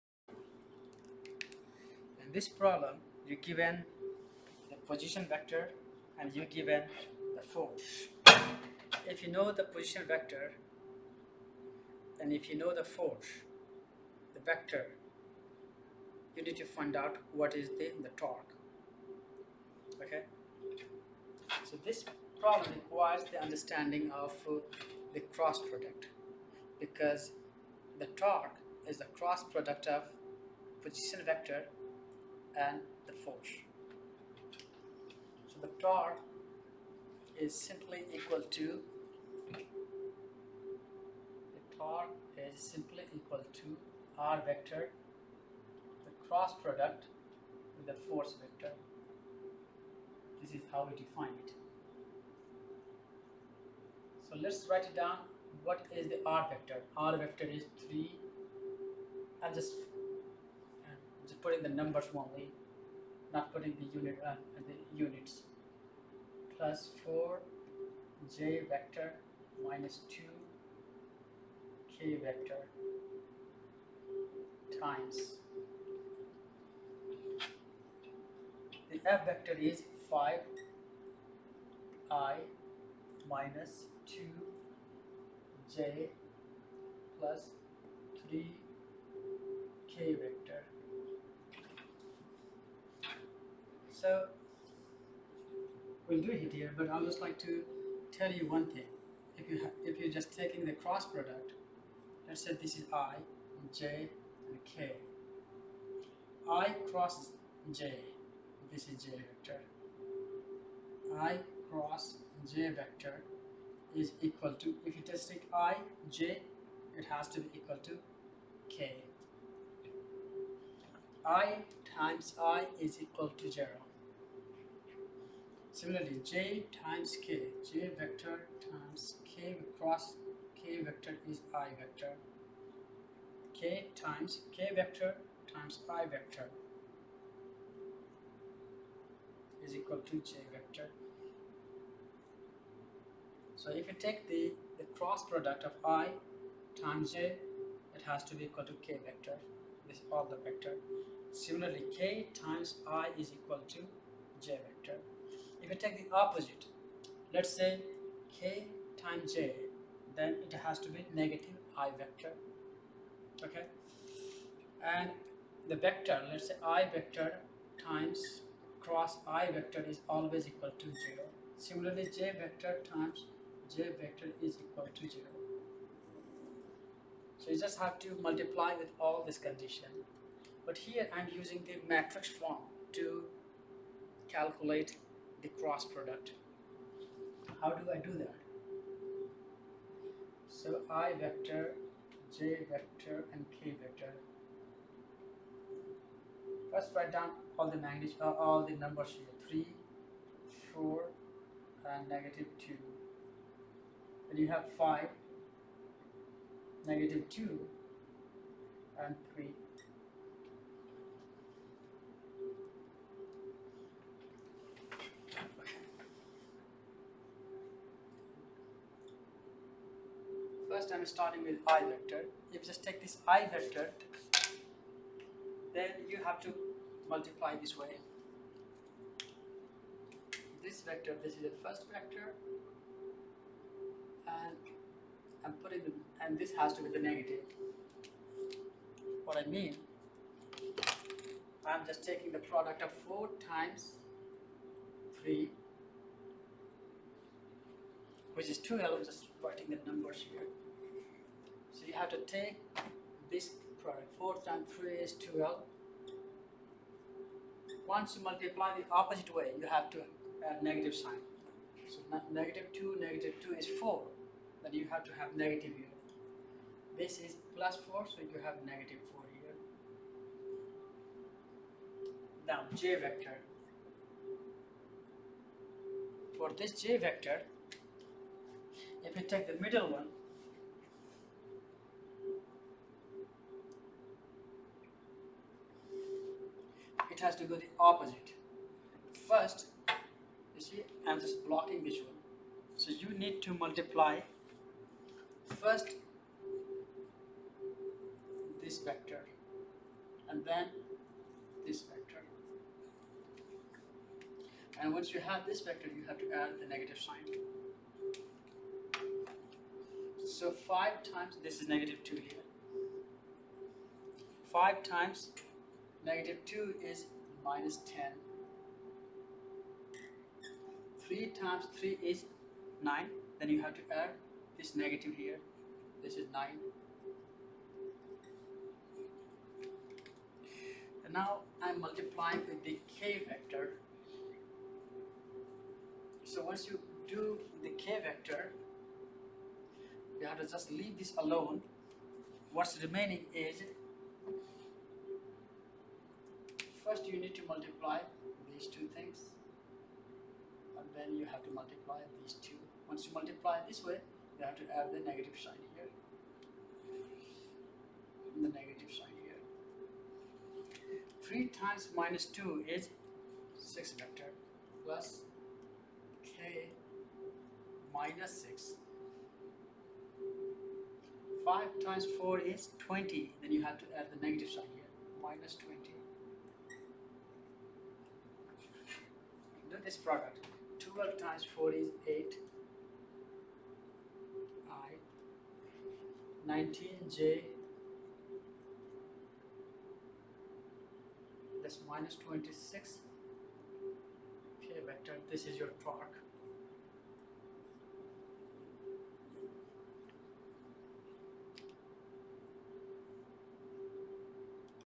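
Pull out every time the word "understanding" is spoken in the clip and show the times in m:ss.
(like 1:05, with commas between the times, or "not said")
0:23.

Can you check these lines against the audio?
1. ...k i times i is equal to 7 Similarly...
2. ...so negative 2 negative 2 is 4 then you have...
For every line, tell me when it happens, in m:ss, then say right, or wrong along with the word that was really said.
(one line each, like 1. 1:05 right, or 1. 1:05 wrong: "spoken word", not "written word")
1. 1:58 wrong: "0", not "7"
2. 4:21 right.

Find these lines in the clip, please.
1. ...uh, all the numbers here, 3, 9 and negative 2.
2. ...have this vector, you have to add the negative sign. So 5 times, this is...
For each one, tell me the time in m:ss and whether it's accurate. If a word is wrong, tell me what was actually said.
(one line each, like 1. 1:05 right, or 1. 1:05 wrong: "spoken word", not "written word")
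1. 3:18 wrong: "4", not "9"
2. 5:05 right.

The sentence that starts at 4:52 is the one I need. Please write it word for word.
So you need to multiply first this vector and then this vector.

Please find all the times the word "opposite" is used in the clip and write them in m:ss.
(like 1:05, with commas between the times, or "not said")
2:36, 4:18, 4:47.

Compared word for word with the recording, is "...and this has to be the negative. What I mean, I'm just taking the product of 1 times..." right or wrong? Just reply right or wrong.
wrong.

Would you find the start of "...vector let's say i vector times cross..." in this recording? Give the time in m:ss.
2:45.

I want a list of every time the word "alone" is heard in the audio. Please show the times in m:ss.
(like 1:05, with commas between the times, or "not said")
5:41.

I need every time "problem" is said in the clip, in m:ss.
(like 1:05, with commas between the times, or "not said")
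0:02, 0:22.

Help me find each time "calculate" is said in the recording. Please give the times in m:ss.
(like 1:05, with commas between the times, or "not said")
3:04.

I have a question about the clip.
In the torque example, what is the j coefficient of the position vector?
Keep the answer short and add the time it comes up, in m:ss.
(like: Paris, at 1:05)
4, at 1:06.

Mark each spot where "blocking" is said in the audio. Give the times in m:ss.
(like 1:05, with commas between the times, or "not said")
4:51.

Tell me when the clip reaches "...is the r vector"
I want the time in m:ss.
0:55.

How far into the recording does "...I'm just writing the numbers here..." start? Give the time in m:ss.
4:08.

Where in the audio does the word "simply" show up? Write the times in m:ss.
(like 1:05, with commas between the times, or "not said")
0:37, 0:42.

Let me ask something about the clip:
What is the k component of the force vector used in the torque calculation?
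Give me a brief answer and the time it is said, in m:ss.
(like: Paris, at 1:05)
3, at 1:27.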